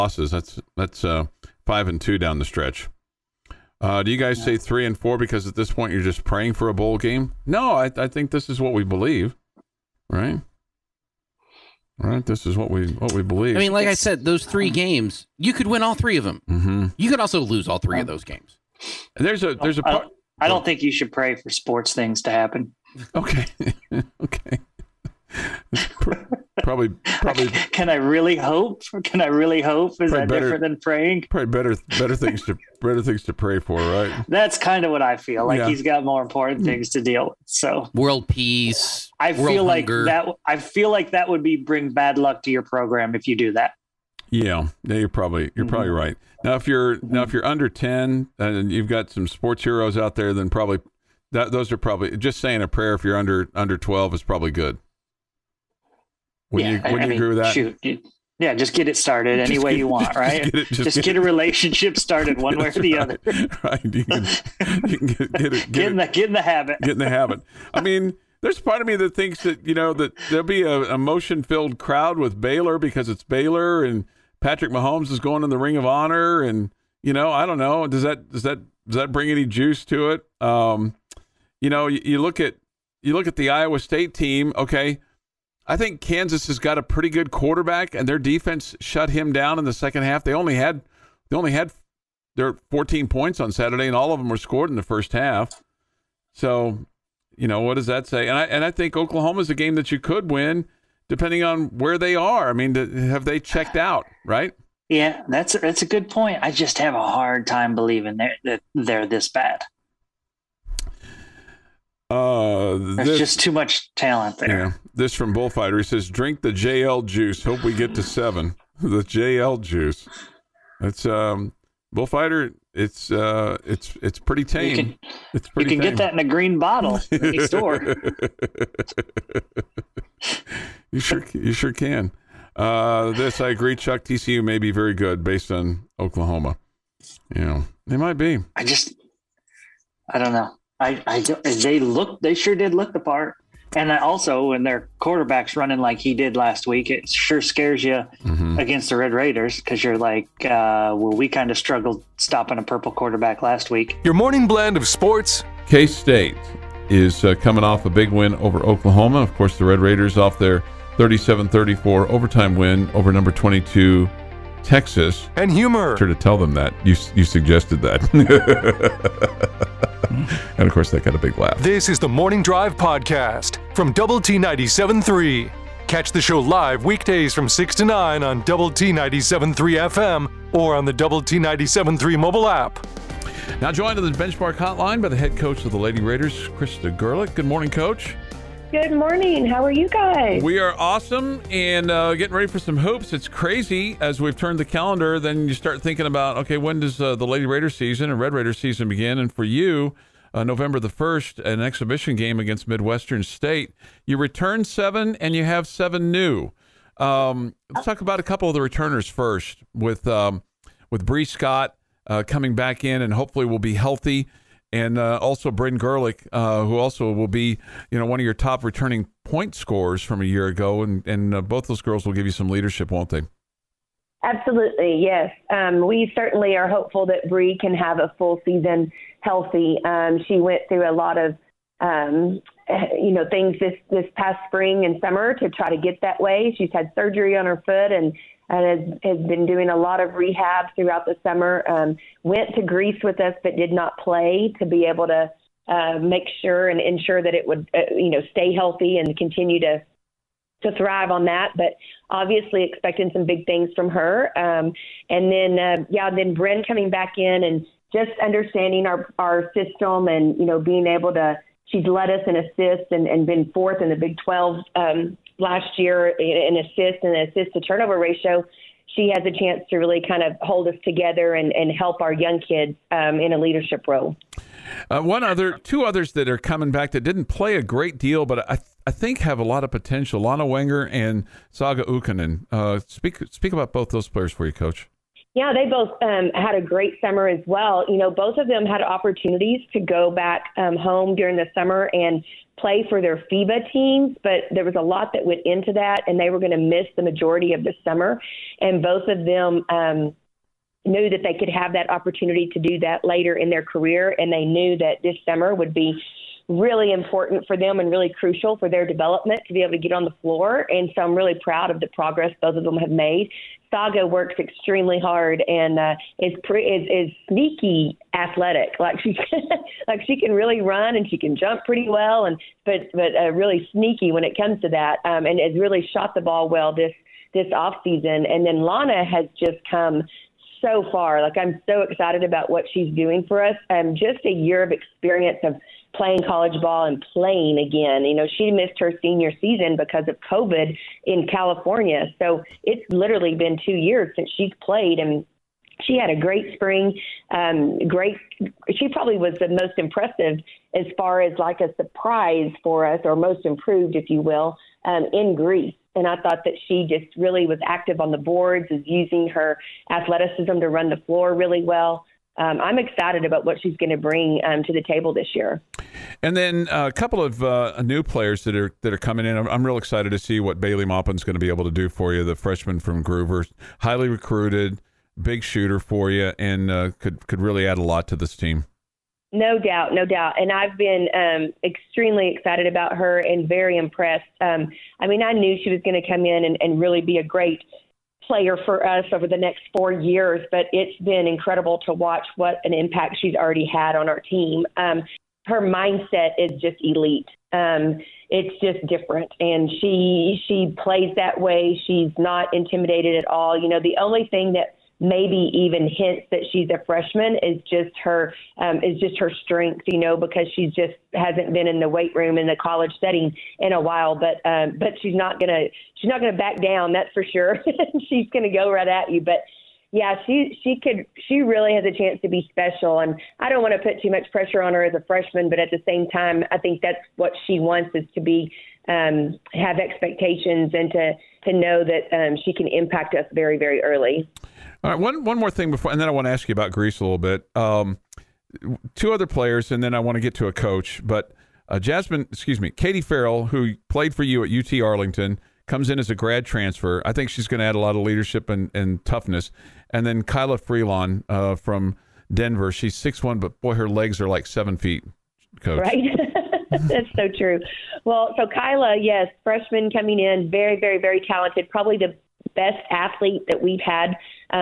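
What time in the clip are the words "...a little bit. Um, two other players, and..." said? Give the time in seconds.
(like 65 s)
436 s.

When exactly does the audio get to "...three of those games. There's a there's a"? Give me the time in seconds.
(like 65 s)
17 s.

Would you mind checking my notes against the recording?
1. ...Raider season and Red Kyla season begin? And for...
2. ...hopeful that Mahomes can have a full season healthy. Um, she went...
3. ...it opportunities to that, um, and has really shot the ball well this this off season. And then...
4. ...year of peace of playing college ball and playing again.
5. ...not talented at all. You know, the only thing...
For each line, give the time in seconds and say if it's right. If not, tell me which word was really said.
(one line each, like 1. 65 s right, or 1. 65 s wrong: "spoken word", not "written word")
1. 197 s wrong: "Raider", not "Kyla"
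2. 226 s wrong: "Bree", not "Mahomes"
3. 324 s wrong: "comes", not "opportunities"
4. 334 s wrong: "experience", not "peace"
5. 402 s wrong: "intimidated", not "talented".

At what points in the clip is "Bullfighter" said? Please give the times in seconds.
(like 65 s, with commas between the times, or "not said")
115 s, 121 s.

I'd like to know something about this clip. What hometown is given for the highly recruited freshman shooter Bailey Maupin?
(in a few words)
Gruver.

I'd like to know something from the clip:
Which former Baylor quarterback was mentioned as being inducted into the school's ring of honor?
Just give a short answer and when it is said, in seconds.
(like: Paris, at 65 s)
Patrick Mahomes, at 74 s.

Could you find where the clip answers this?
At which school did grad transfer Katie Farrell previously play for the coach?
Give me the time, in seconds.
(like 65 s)
444 s.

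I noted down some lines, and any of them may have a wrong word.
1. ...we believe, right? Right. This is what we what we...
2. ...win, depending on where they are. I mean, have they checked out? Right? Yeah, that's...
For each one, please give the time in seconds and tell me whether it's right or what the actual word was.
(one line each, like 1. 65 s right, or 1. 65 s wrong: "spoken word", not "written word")
1. 8 s right
2. 100 s right.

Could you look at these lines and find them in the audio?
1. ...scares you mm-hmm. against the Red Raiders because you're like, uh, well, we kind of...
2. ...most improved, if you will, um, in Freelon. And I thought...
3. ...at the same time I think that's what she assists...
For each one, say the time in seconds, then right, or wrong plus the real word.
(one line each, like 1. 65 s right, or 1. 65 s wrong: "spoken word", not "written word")
1. 147 s right
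2. 353 s wrong: "Greece", not "Freelon"
3. 425 s wrong: "wants", not "assists".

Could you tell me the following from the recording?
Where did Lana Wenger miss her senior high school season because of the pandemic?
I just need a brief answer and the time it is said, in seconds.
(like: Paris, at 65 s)
California, at 341 s.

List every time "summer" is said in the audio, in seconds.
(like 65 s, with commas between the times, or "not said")
235 s, 241 s, 286 s, 291 s, 297 s, 305 s.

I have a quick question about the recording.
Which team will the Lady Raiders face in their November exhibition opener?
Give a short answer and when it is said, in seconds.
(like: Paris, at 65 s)
Midwestern State, at 202 s.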